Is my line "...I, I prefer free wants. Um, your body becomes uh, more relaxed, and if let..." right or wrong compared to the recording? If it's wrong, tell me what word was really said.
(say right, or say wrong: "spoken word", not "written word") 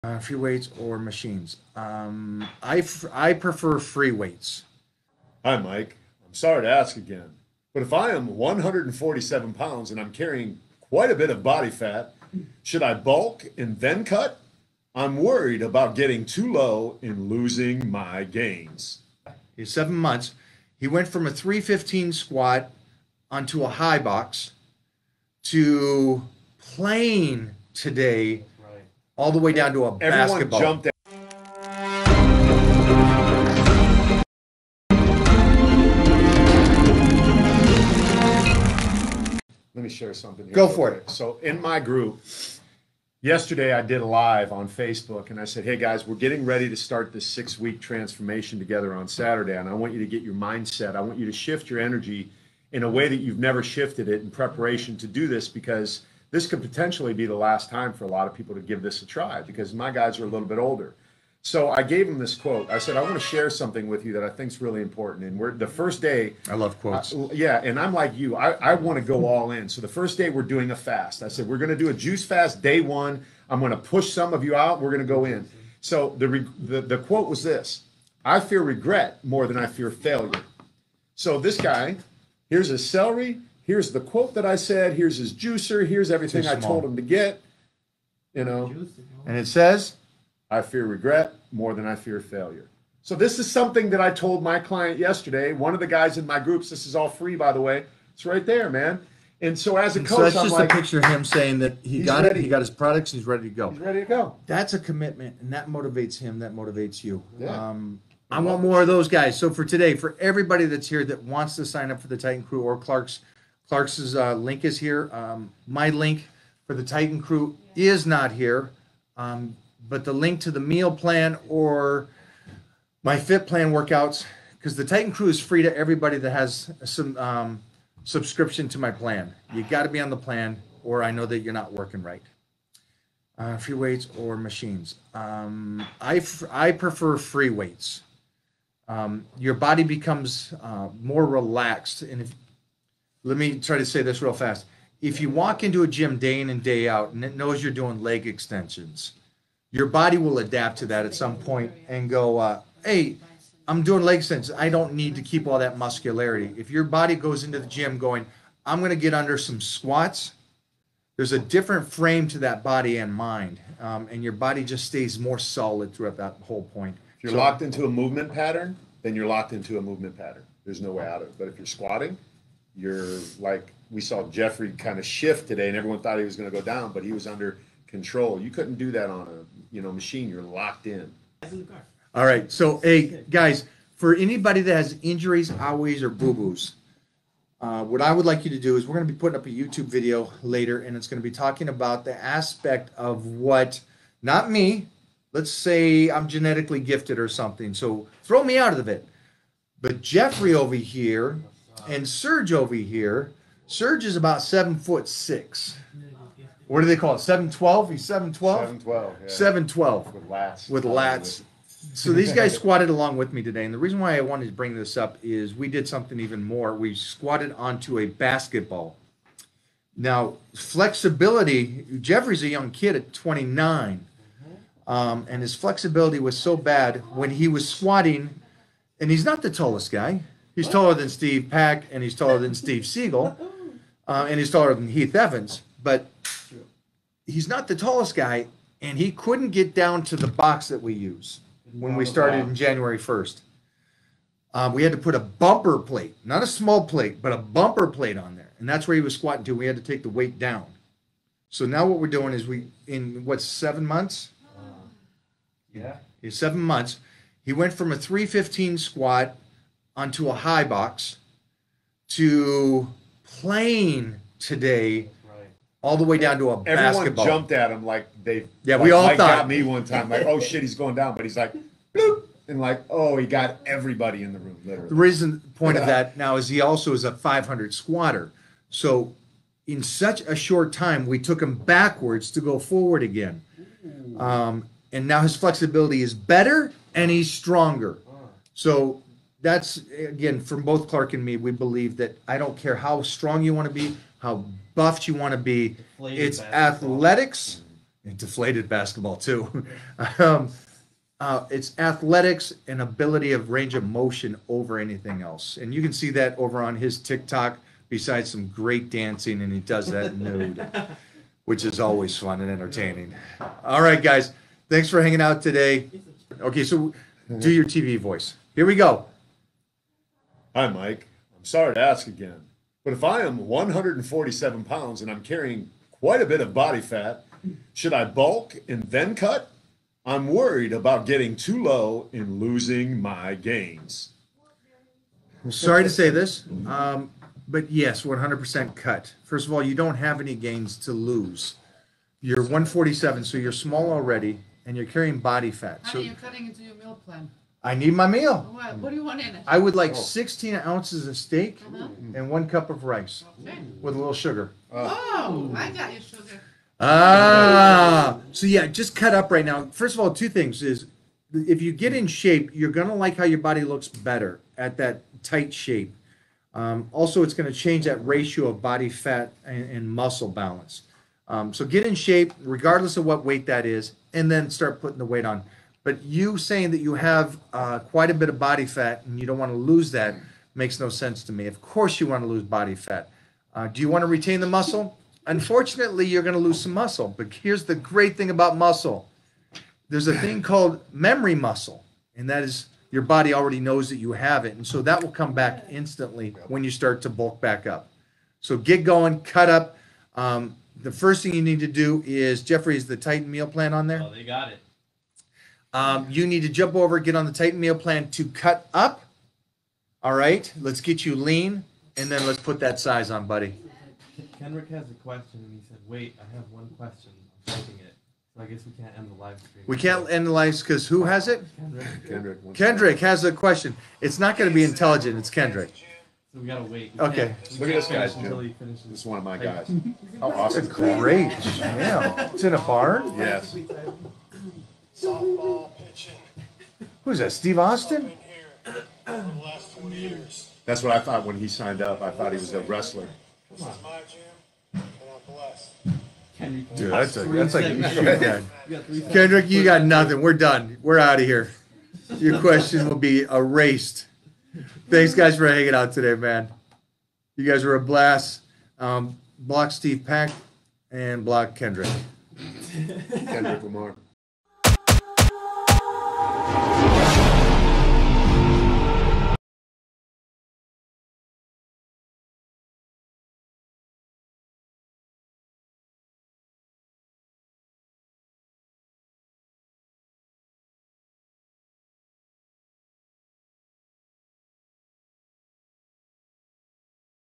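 wrong: "weights", not "wants".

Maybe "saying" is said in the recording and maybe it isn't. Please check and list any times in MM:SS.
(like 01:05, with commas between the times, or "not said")
01:41, 06:16.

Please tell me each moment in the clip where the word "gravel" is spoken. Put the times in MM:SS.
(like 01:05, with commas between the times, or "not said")
not said.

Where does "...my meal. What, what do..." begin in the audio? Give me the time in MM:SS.
05:47.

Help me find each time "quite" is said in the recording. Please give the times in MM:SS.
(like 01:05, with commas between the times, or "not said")
00:10, 05:25, 06:17.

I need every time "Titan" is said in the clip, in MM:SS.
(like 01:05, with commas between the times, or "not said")
01:52, 01:56, 02:04, 06:42, 06:47.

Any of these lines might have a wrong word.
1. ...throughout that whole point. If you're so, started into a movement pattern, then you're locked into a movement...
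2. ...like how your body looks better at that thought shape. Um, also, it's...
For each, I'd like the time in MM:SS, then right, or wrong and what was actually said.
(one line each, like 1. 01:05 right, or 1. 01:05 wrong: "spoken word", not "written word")
1. 02:45 wrong: "locked", not "started"
2. 06:02 wrong: "tight", not "thought".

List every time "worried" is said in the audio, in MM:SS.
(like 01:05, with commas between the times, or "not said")
00:15, 05:30.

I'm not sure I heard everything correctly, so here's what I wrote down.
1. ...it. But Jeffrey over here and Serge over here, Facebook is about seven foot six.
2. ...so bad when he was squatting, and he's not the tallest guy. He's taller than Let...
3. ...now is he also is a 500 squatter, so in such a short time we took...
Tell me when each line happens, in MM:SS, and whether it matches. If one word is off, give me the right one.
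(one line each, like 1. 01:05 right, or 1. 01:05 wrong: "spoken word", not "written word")
1. 03:18 wrong: "Serge", not "Facebook"
2. 03:46 wrong: "Steve", not "Let"
3. 04:36 right.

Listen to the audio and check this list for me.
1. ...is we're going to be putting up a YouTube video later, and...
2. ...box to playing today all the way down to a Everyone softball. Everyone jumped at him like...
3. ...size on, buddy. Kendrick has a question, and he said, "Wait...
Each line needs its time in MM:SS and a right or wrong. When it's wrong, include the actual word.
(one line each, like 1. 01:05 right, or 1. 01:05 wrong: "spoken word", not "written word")
1. 03:08 right
2. 04:20 wrong: "basketball", not "softball"
3. 06:52 right.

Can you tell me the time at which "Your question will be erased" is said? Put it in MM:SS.
07:32.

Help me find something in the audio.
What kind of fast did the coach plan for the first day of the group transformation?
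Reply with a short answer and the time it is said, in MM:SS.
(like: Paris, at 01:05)
Juice fast, at 01:11.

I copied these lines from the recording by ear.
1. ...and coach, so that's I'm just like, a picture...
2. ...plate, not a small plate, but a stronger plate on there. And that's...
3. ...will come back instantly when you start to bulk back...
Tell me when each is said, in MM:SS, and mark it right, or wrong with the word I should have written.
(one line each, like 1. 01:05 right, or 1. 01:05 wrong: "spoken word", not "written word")
1. 01:39 right
2. 04:05 wrong: "bumper", not "stronger"
3. 06:35 right.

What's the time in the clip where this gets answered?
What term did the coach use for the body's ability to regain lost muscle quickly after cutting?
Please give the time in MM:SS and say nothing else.
06:30.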